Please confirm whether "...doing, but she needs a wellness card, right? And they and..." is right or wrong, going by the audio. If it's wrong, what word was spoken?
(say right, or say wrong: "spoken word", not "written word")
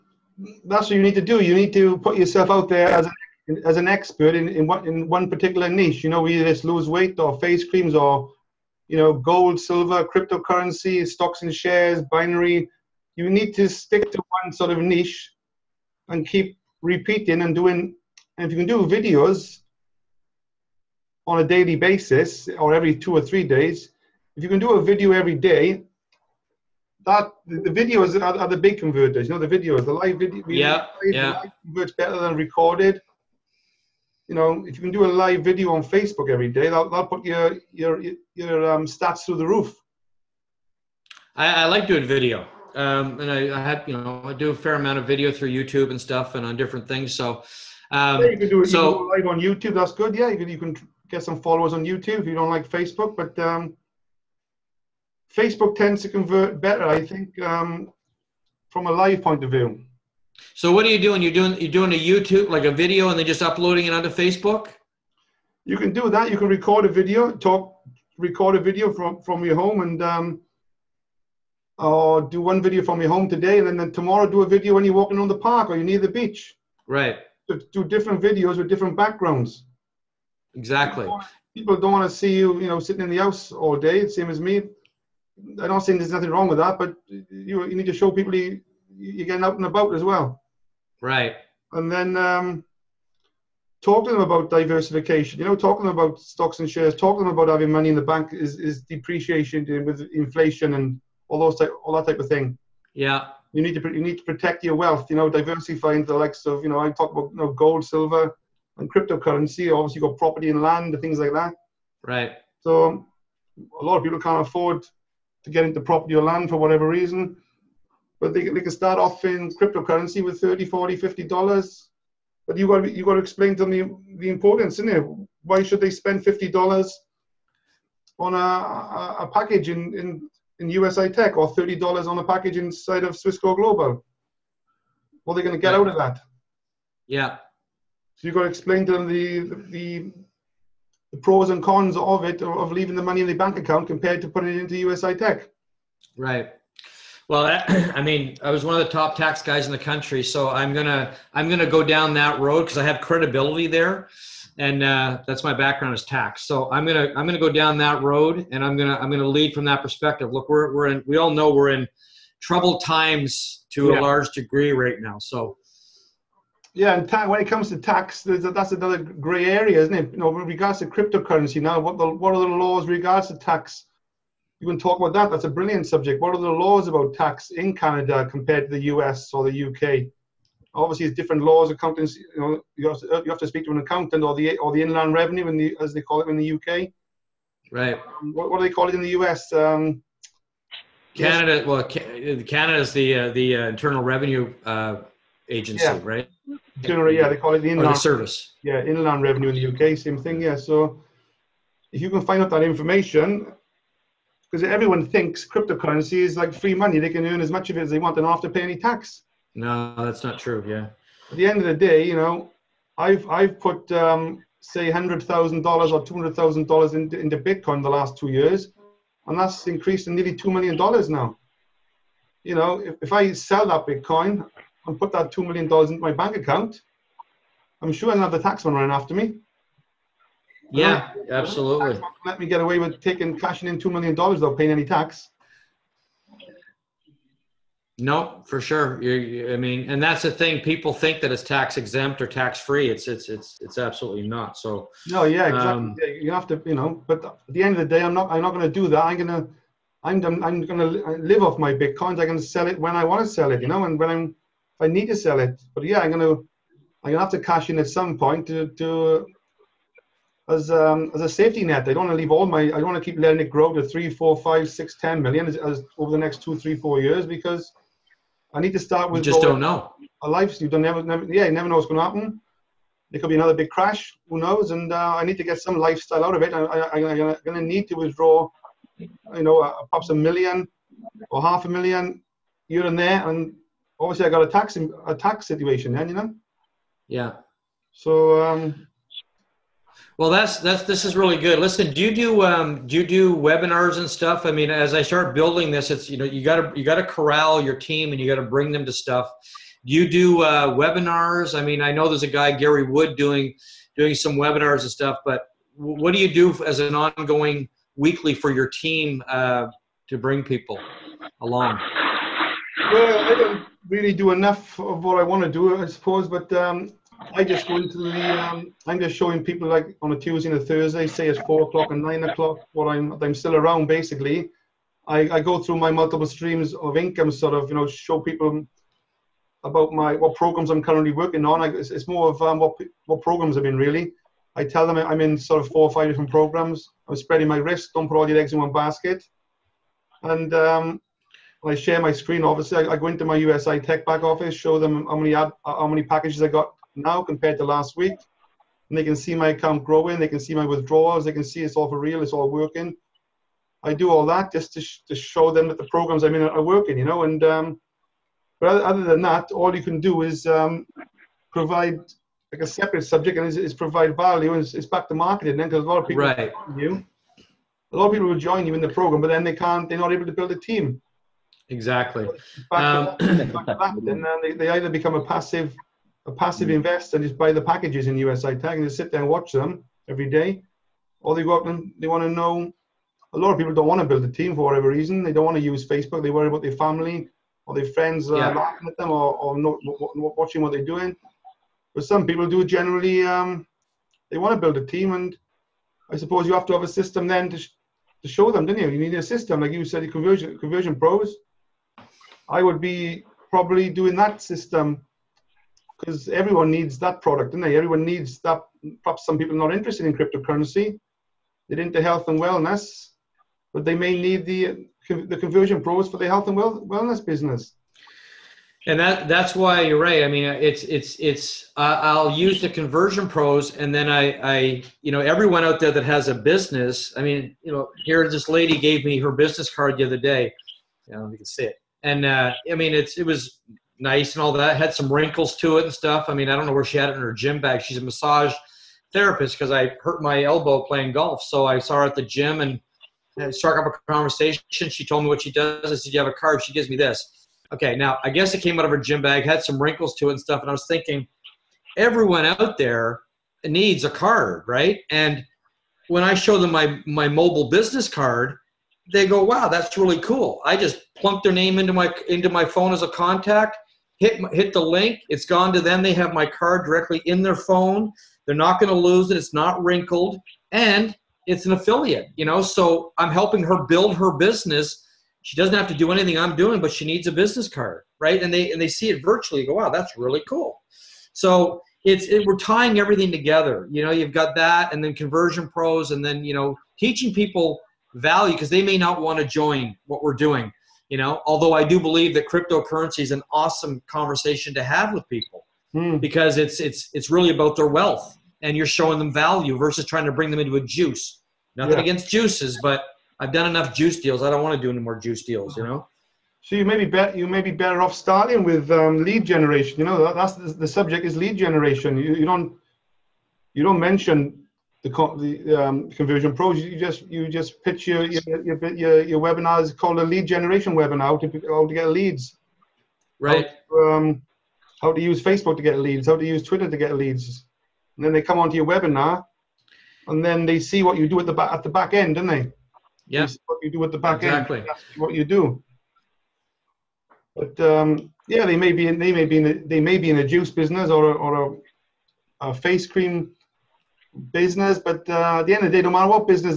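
wrong: "business", not "wellness".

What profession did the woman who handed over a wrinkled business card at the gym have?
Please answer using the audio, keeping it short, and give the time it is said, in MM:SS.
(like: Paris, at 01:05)
massage therapist, at 07:18.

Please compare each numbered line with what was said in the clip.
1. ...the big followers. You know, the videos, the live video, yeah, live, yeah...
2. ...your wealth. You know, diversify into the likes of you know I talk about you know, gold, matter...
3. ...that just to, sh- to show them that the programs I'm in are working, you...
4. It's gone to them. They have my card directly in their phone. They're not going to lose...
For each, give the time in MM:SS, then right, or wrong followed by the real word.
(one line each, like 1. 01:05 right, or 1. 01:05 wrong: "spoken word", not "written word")
1. 00:28 wrong: "converters", not "followers"
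2. 01:44 wrong: "silver", not "matter"
3. 05:54 right
4. 07:45 right.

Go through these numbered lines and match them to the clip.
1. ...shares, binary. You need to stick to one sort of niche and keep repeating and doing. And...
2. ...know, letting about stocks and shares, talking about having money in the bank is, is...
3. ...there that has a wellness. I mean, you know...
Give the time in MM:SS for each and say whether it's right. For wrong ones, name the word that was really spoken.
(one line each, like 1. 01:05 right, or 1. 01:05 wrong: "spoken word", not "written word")
1. 00:11 right
2. 01:35 wrong: "talking", not "letting"
3. 07:05 wrong: "business", not "wellness".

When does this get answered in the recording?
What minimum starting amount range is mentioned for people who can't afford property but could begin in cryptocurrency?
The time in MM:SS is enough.
02:00.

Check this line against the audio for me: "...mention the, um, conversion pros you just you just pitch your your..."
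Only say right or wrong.
right.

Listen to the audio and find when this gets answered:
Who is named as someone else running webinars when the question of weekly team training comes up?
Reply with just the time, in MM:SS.
05:02.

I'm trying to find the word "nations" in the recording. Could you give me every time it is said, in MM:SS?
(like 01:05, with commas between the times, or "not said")
not said.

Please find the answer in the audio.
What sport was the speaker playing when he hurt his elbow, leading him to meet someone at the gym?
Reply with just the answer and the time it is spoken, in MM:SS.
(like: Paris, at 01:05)
golf, at 07:20.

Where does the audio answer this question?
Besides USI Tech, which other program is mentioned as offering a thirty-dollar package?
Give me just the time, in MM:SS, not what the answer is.
02:13.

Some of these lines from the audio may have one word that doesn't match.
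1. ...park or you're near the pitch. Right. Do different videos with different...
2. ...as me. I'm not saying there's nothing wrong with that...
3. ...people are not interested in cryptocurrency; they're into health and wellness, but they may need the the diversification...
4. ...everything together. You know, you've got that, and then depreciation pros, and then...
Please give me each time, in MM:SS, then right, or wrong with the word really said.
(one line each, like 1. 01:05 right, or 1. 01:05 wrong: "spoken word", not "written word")
1. 01:15 wrong: "beach", not "pitch"
2. 01:24 right
3. 06:49 wrong: "conversion", not "diversification"
4. 08:02 wrong: "conversion", not "depreciation".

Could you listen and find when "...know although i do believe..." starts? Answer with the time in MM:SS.
08:11.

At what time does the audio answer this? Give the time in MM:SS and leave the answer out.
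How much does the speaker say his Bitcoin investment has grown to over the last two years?
03:40.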